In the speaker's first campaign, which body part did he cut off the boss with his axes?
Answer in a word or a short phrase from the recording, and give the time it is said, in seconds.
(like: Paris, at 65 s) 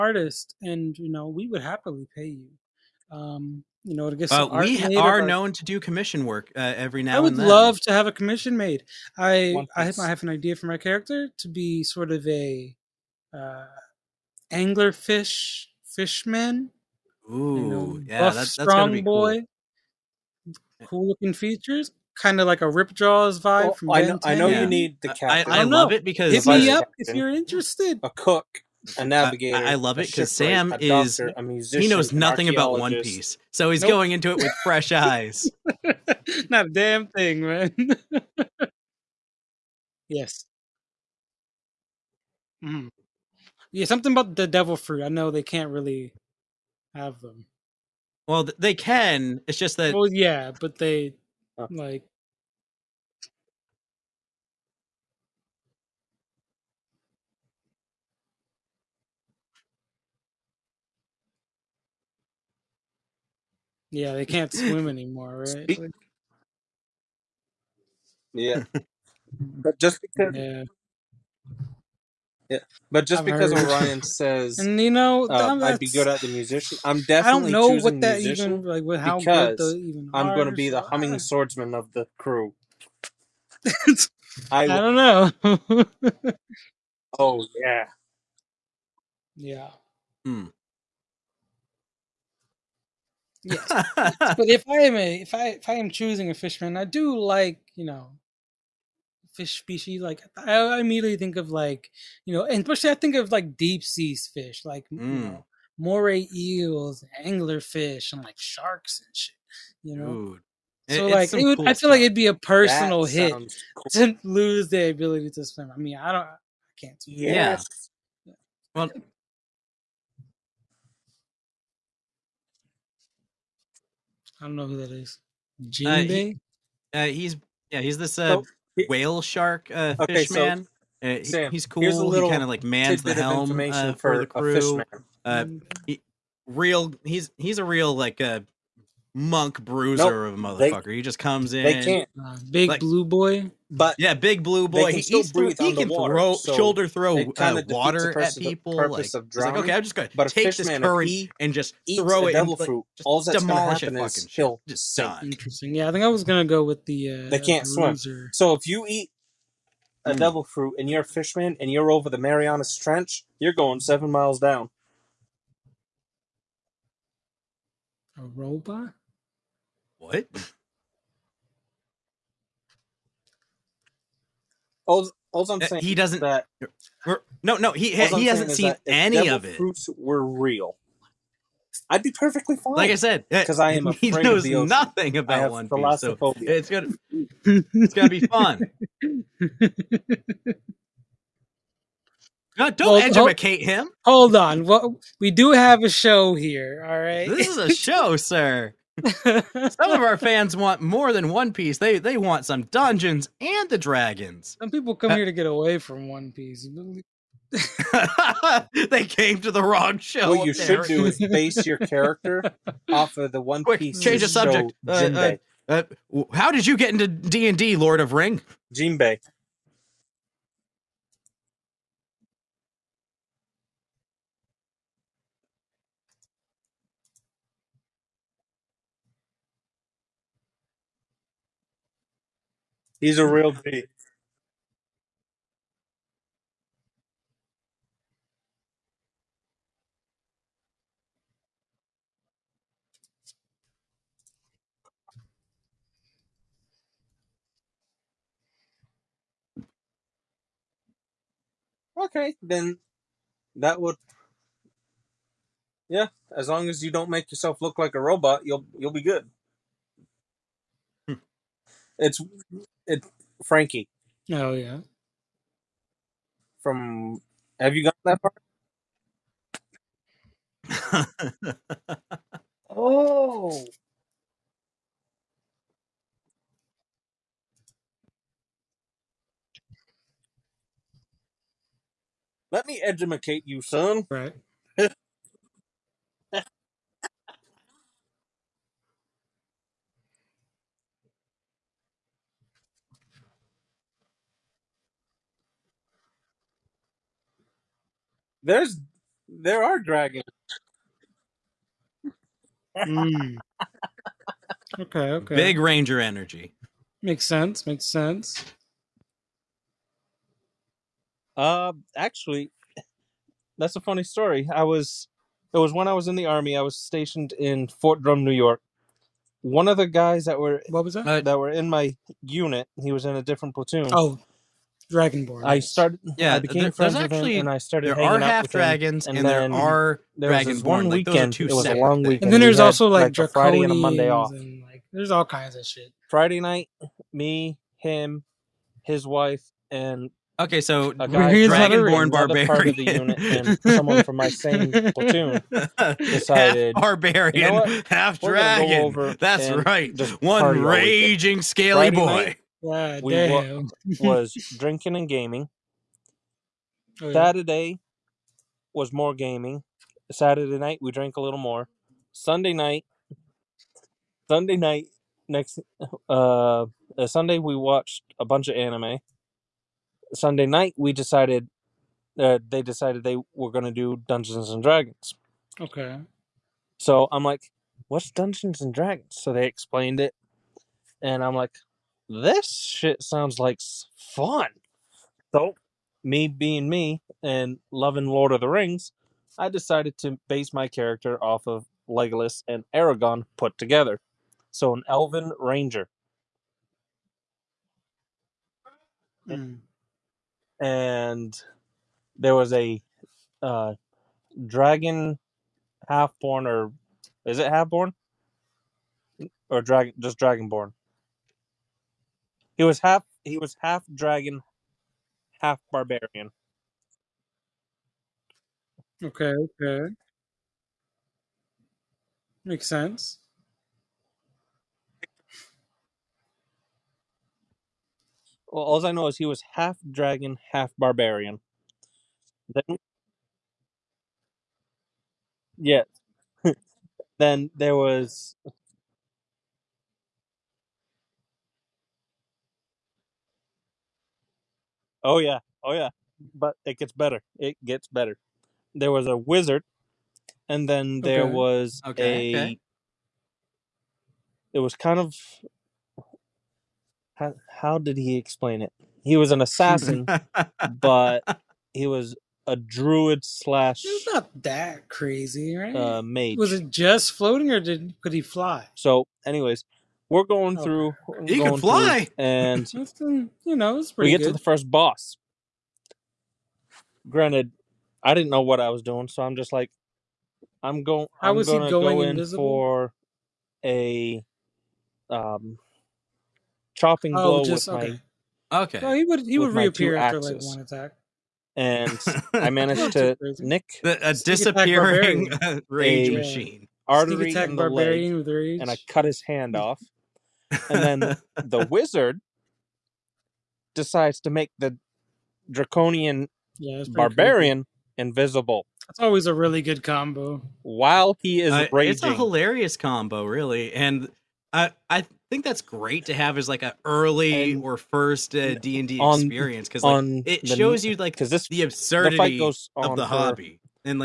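Hand, at 499 s.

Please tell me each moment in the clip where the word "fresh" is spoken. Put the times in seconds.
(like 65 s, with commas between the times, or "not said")
34 s.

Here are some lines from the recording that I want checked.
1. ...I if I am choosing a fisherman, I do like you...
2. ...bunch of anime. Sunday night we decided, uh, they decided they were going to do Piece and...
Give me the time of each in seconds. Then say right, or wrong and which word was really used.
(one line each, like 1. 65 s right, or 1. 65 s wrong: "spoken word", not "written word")
1. 95 s right
2. 368 s wrong: "Dungeons", not "Piece".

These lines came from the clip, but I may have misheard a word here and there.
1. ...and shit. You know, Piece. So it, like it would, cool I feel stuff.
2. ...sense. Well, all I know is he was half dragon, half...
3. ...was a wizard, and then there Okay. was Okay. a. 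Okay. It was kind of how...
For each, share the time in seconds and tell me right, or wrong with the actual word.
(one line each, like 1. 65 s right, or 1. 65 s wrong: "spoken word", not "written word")
1. 109 s wrong: "Dude", not "Piece"
2. 422 s right
3. 448 s right.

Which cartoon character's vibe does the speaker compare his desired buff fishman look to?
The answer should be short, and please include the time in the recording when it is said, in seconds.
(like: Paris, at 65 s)
Rip Jaws, at 22 s.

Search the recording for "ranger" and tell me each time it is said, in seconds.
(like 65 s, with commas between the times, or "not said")
305 s, 395 s.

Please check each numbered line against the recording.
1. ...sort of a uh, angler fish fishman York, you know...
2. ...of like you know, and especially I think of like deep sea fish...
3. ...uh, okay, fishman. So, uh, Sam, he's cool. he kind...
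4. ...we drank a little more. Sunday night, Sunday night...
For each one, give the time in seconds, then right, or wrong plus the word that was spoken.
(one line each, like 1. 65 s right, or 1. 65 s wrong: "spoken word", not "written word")
1. 11 s wrong: "Ooh", not "York"
2. 101 s right
3. 129 s right
4. 360 s right.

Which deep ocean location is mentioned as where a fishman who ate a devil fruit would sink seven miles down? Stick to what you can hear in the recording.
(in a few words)
Marianas Trench.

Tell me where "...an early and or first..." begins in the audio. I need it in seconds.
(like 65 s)
516 s.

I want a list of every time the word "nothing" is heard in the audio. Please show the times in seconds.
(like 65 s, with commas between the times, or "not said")
32 s, 184 s.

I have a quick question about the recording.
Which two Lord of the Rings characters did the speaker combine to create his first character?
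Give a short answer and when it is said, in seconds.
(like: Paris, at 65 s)
Legolas and Aragon, at 391 s.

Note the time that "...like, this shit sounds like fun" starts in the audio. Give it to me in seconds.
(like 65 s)
381 s.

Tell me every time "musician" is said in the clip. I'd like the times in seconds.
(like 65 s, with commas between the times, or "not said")
31 s, 76 s.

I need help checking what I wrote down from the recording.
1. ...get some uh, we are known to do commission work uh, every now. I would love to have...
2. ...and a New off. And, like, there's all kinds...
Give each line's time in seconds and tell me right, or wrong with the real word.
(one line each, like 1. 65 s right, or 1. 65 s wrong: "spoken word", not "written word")
1. 4 s right
2. 333 s wrong: "Monday", not "New".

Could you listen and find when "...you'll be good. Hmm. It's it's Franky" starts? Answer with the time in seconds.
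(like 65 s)
258 s.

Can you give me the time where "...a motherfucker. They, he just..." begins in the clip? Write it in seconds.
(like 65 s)
140 s.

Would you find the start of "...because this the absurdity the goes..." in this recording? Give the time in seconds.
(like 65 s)
521 s.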